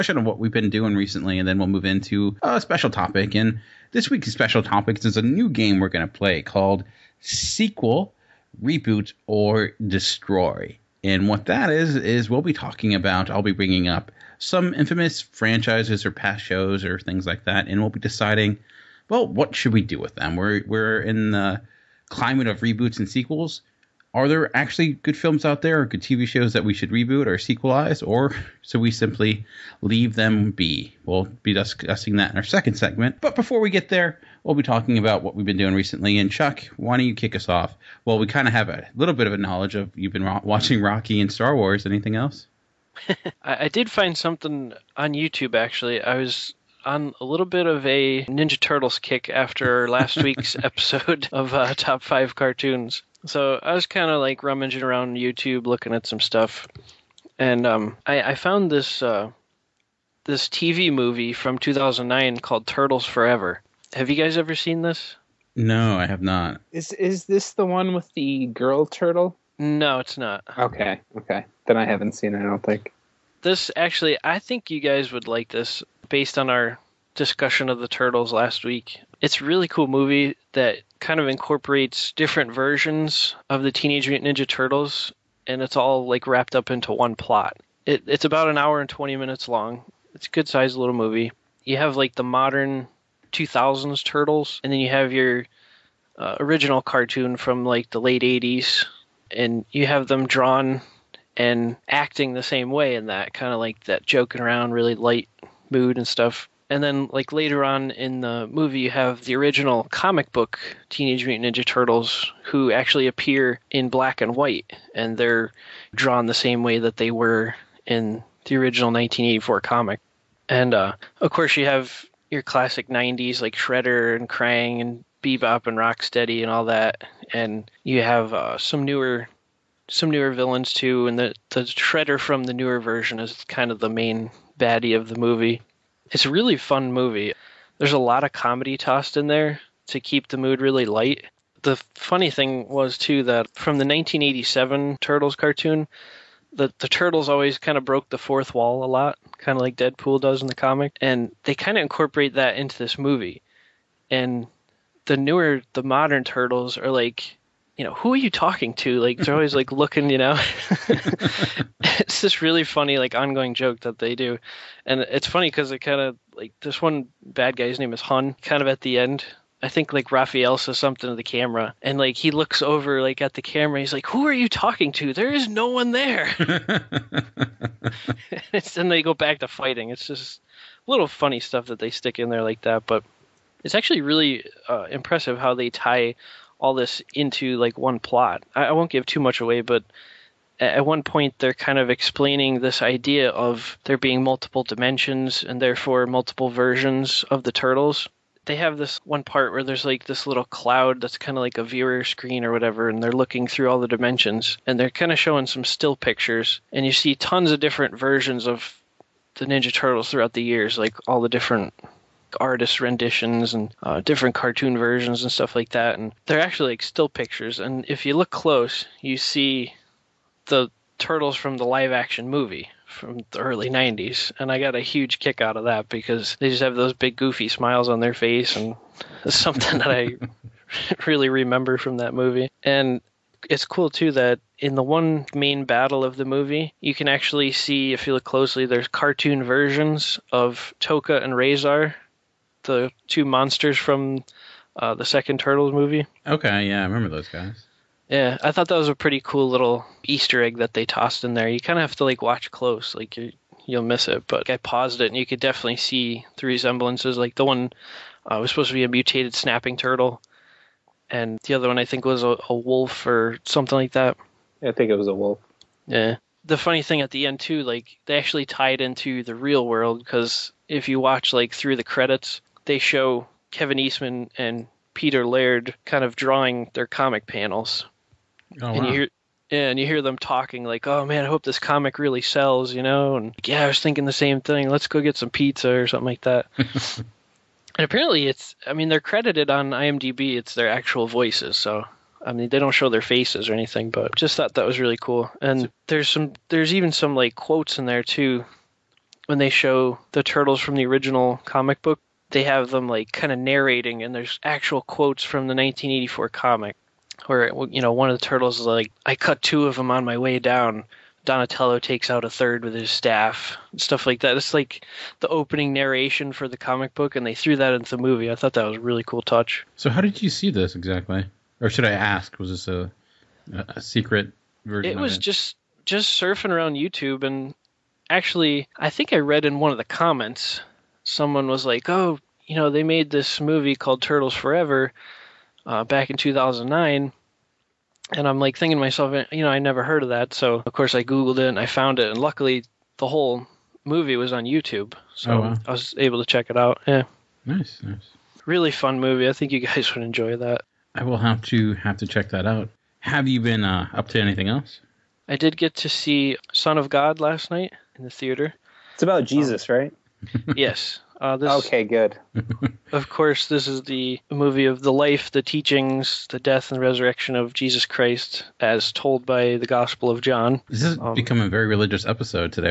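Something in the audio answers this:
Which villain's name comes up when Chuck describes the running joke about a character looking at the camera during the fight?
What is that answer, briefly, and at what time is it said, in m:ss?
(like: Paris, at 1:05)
Hun, at 2:48.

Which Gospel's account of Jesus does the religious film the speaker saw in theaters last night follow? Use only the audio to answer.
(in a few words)
John.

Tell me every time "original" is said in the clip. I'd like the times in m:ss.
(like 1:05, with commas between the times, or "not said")
1:36, 1:49, 1:58, 5:00.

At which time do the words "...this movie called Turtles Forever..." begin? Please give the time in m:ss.
5:33.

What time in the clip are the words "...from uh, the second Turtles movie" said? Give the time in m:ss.
4:03.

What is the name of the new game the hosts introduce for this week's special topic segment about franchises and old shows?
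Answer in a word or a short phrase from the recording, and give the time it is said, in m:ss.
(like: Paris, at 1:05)
Sequel, Reboot, or Destroy, at 0:07.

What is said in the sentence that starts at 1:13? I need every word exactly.
This actually I think you guys would like this based on our discussion of the Turtles last week.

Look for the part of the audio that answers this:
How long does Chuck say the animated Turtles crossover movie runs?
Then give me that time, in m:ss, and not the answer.
1:28.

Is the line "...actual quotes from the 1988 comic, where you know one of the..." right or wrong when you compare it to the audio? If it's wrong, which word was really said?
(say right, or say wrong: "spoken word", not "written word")
wrong: "1984", not "1988".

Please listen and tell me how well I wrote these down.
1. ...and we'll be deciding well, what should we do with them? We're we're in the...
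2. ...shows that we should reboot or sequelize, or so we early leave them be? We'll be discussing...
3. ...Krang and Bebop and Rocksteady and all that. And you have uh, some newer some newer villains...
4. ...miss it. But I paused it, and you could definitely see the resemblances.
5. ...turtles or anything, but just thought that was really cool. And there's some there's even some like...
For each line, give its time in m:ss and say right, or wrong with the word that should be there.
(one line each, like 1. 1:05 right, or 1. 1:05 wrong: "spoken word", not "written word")
1. 0:17 right
2. 0:26 wrong: "simply", not "early"
3. 2:04 right
4. 4:13 right
5. 4:53 wrong: "faces", not "turtles".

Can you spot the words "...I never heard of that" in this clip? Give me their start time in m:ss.
5:39.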